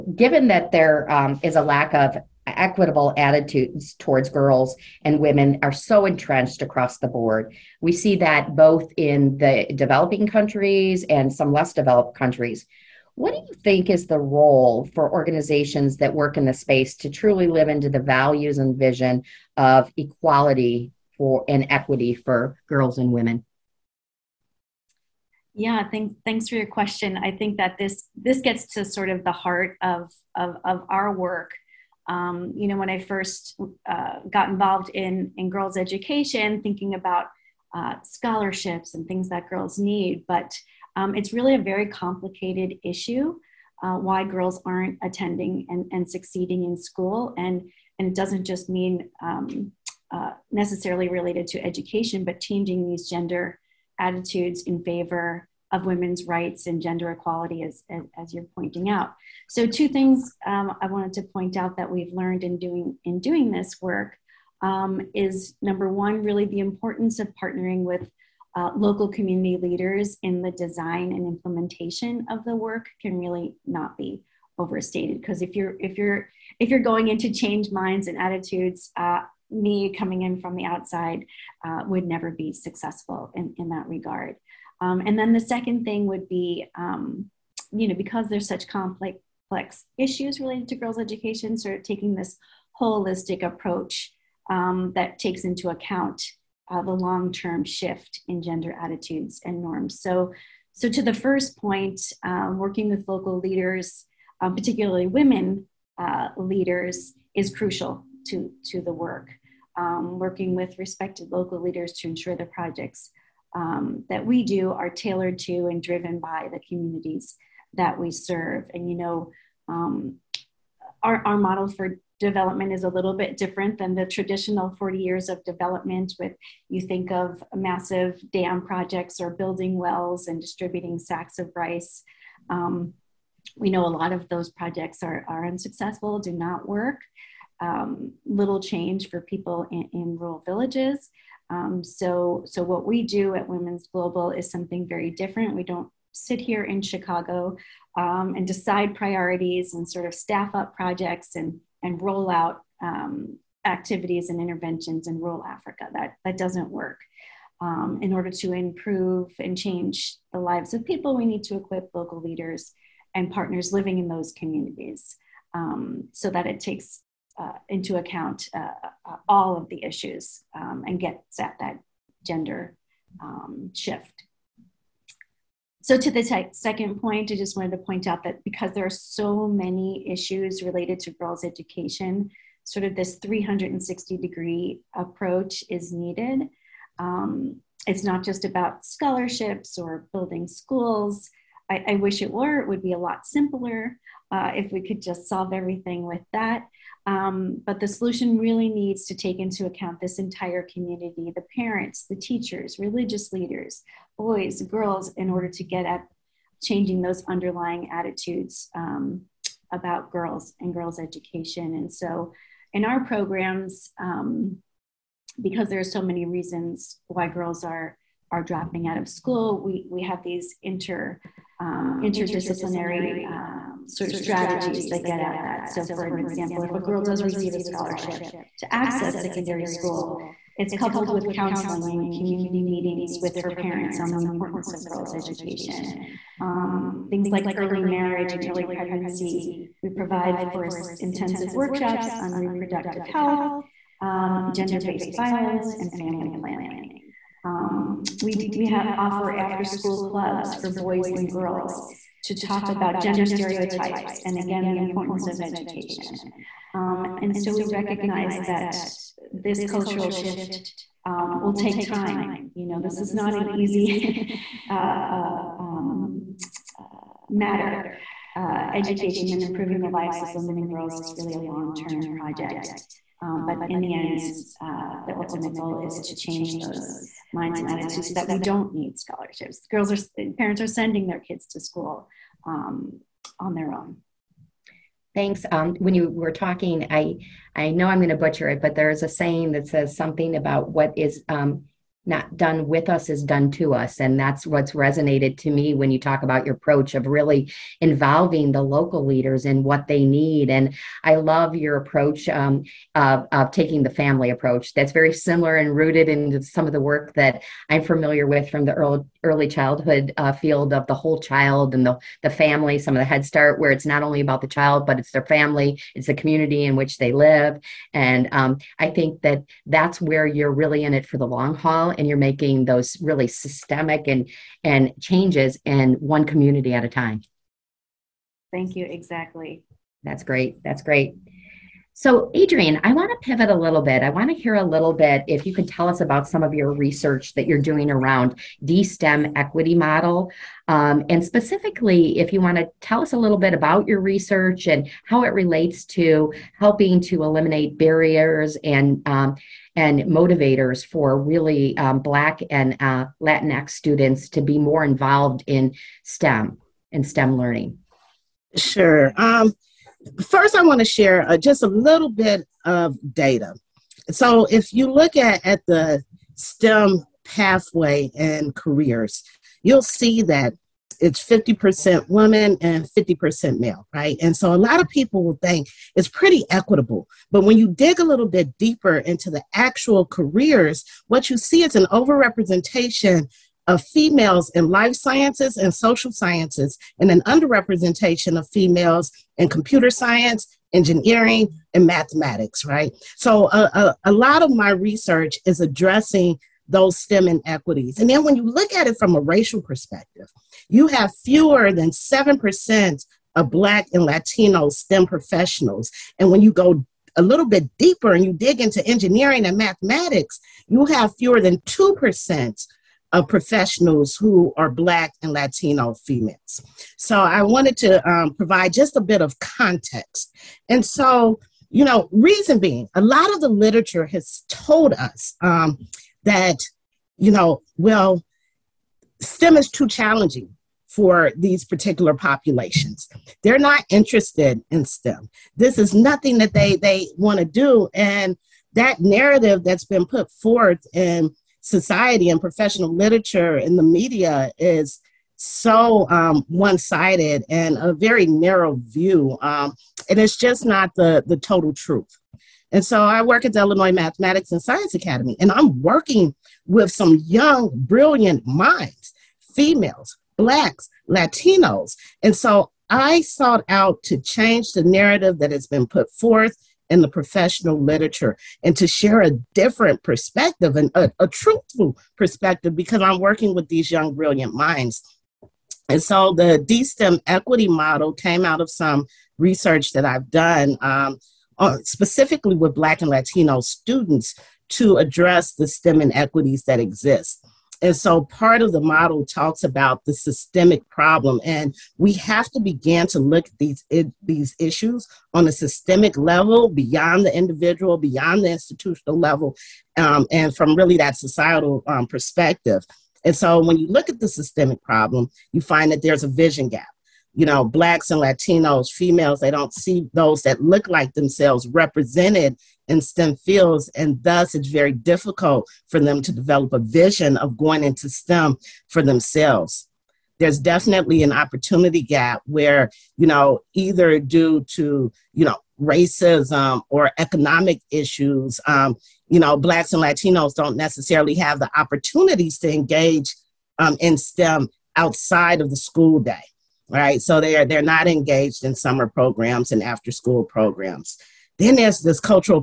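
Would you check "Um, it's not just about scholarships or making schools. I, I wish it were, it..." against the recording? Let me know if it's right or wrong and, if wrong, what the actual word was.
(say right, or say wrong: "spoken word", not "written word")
wrong: "building", not "making".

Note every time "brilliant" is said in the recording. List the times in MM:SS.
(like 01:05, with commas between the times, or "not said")
07:37, 07:54.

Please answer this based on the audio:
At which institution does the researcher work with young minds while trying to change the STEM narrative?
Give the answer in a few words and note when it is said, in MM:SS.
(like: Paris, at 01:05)
Illinois Mathematics and Science Academy, at 07:33.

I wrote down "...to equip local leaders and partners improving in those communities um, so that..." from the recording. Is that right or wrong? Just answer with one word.
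wrong.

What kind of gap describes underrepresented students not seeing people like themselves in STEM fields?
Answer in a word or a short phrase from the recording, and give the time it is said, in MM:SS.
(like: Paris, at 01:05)
vision gap, at 08:26.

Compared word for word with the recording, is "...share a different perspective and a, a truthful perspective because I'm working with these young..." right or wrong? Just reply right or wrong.
right.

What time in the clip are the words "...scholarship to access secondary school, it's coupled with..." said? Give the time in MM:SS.
03:47.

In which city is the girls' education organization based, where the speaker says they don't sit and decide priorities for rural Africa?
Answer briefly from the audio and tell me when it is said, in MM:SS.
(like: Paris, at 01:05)
Chicago, at 02:26.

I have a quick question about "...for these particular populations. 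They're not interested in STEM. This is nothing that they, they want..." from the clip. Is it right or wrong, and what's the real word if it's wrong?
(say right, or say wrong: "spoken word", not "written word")
right.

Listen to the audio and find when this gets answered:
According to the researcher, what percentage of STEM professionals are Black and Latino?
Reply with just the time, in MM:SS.
06:41.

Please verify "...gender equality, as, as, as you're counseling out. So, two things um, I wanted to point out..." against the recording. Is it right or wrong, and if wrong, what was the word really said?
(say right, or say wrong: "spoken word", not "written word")
wrong: "pointing", not "counseling".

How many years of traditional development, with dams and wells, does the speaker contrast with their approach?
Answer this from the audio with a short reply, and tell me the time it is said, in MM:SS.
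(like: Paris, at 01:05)
40, at 02:04.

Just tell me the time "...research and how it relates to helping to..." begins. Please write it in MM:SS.
05:43.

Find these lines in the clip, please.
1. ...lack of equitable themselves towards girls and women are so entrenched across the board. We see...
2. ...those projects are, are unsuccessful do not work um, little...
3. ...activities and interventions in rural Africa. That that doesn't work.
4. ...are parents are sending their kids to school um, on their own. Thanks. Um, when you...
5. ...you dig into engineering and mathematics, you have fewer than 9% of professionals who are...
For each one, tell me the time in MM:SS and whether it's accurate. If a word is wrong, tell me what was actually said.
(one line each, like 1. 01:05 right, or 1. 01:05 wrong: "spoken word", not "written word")
1. 00:01 wrong: "attitudes", not "themselves"
2. 02:14 right
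3. 02:33 right
4. 04:39 right
5. 06:48 wrong: "2", not "9".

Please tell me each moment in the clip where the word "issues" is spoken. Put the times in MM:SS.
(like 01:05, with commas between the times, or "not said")
00:42, 01:29, 02:49, 03:00, 08:14, 08:47.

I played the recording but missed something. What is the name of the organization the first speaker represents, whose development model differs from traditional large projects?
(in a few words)
Women's Global.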